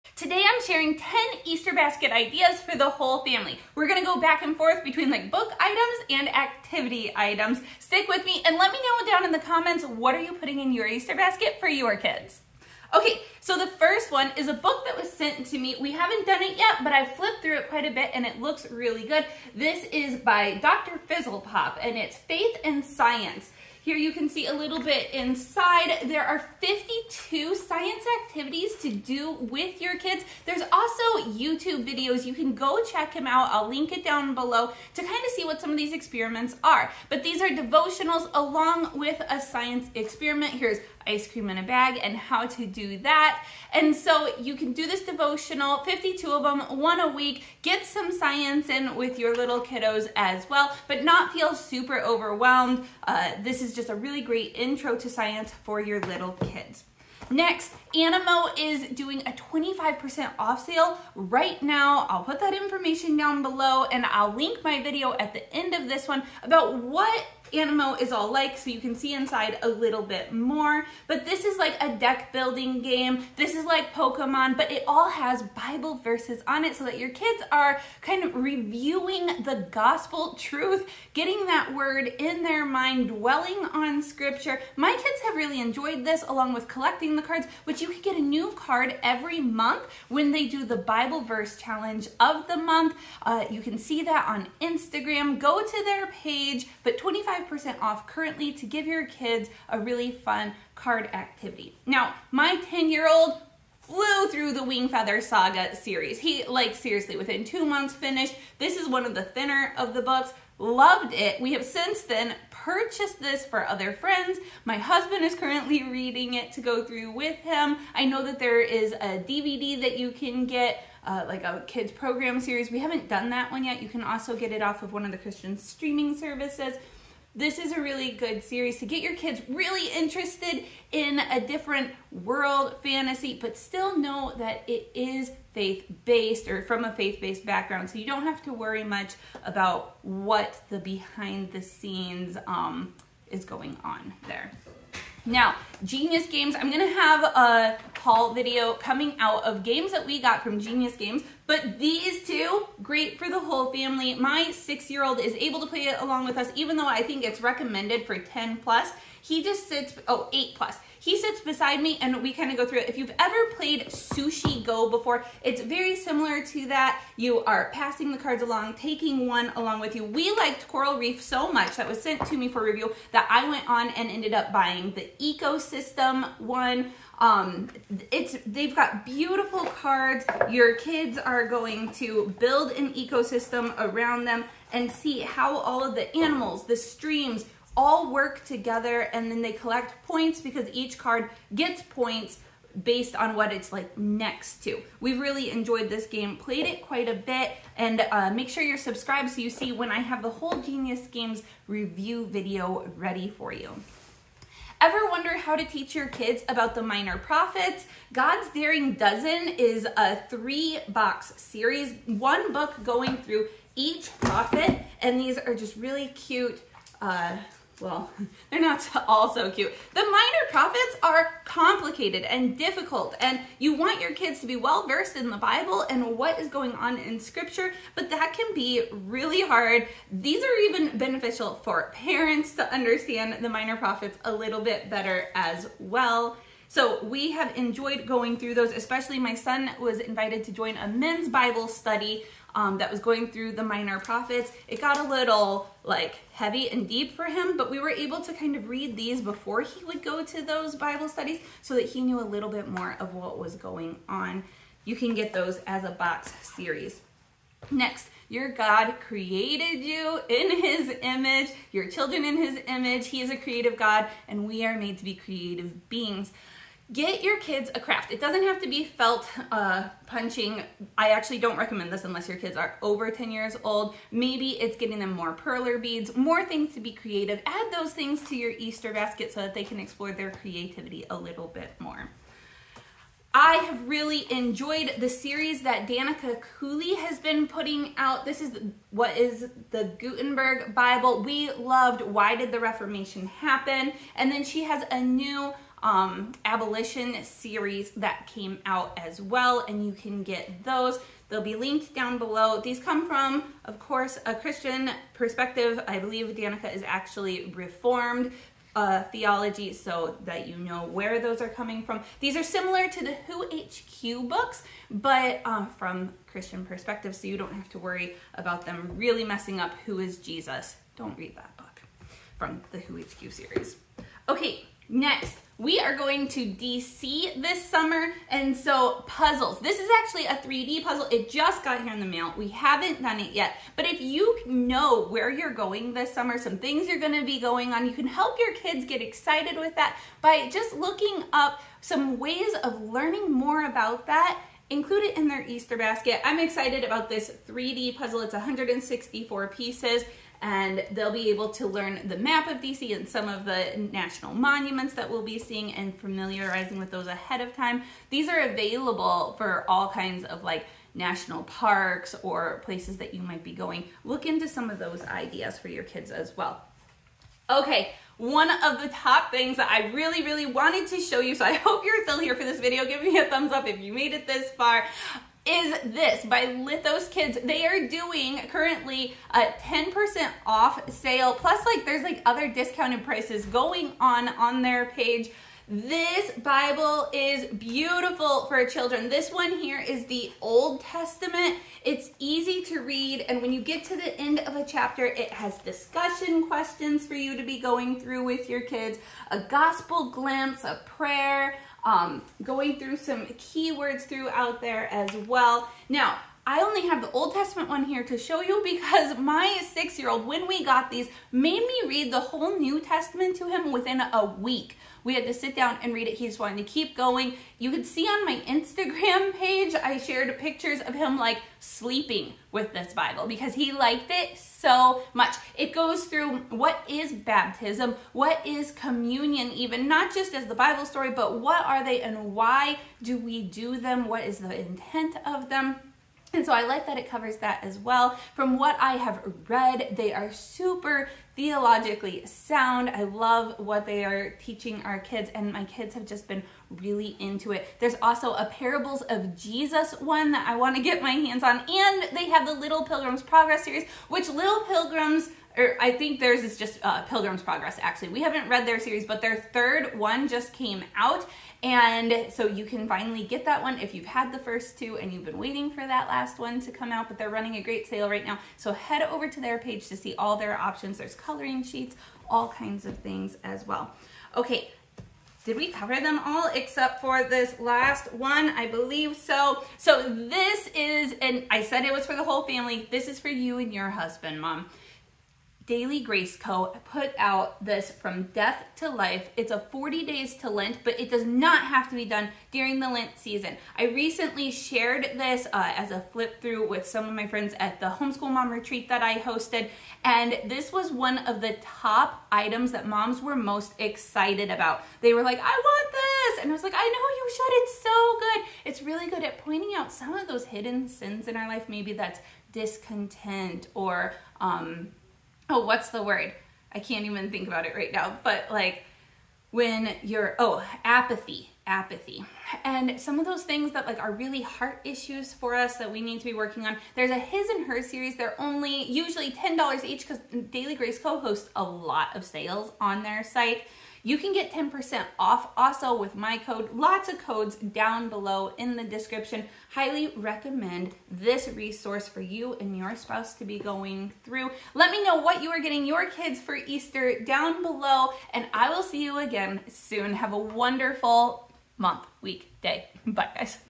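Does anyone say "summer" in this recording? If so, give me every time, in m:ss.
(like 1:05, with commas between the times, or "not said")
5:27, 5:36.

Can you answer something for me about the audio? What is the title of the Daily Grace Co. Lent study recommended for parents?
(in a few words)
From Death to Life.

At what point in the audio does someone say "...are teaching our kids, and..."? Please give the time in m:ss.
7:24.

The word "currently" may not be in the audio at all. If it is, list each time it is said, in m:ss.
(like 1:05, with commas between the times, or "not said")
1:38, 1:55, 6:18.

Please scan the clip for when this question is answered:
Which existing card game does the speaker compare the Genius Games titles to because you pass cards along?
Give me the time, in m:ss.
2:43.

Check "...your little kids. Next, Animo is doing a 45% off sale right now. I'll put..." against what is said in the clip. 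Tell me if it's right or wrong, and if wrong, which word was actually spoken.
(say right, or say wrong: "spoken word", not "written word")
wrong: "25", not "45".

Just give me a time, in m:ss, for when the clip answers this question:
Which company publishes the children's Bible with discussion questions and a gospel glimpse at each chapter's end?
6:16.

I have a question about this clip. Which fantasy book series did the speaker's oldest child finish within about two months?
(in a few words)
Wingfeather Saga.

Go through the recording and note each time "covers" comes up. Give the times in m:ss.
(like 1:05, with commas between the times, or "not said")
7:17, 7:55.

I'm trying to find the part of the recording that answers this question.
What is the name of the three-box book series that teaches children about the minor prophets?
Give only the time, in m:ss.
3:28.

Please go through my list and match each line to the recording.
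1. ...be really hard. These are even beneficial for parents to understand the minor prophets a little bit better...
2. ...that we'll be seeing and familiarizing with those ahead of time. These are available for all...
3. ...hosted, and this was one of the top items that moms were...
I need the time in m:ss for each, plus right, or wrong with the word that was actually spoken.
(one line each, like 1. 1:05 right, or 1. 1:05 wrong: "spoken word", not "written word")
1. 3:48 right
2. 5:54 right
3. 8:19 right.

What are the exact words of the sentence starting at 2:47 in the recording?
You are passing the cards along, taking one along with you.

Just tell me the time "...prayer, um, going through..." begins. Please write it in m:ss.
6:40.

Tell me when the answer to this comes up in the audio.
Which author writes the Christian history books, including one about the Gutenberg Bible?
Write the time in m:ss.
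4:45.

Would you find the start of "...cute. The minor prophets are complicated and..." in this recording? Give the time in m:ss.
3:39.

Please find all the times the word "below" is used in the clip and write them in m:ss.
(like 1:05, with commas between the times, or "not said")
0:34, 1:03, 5:02, 8:58, 9:07.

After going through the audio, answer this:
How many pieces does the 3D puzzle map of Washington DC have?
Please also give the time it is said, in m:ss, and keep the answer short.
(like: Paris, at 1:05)
164, at 5:48.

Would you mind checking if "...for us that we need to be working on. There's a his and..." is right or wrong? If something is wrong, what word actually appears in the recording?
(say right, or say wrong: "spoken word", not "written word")
right.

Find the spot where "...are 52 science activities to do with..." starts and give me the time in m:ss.
0:26.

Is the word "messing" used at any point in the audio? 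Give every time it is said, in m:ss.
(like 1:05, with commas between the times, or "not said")
5:19.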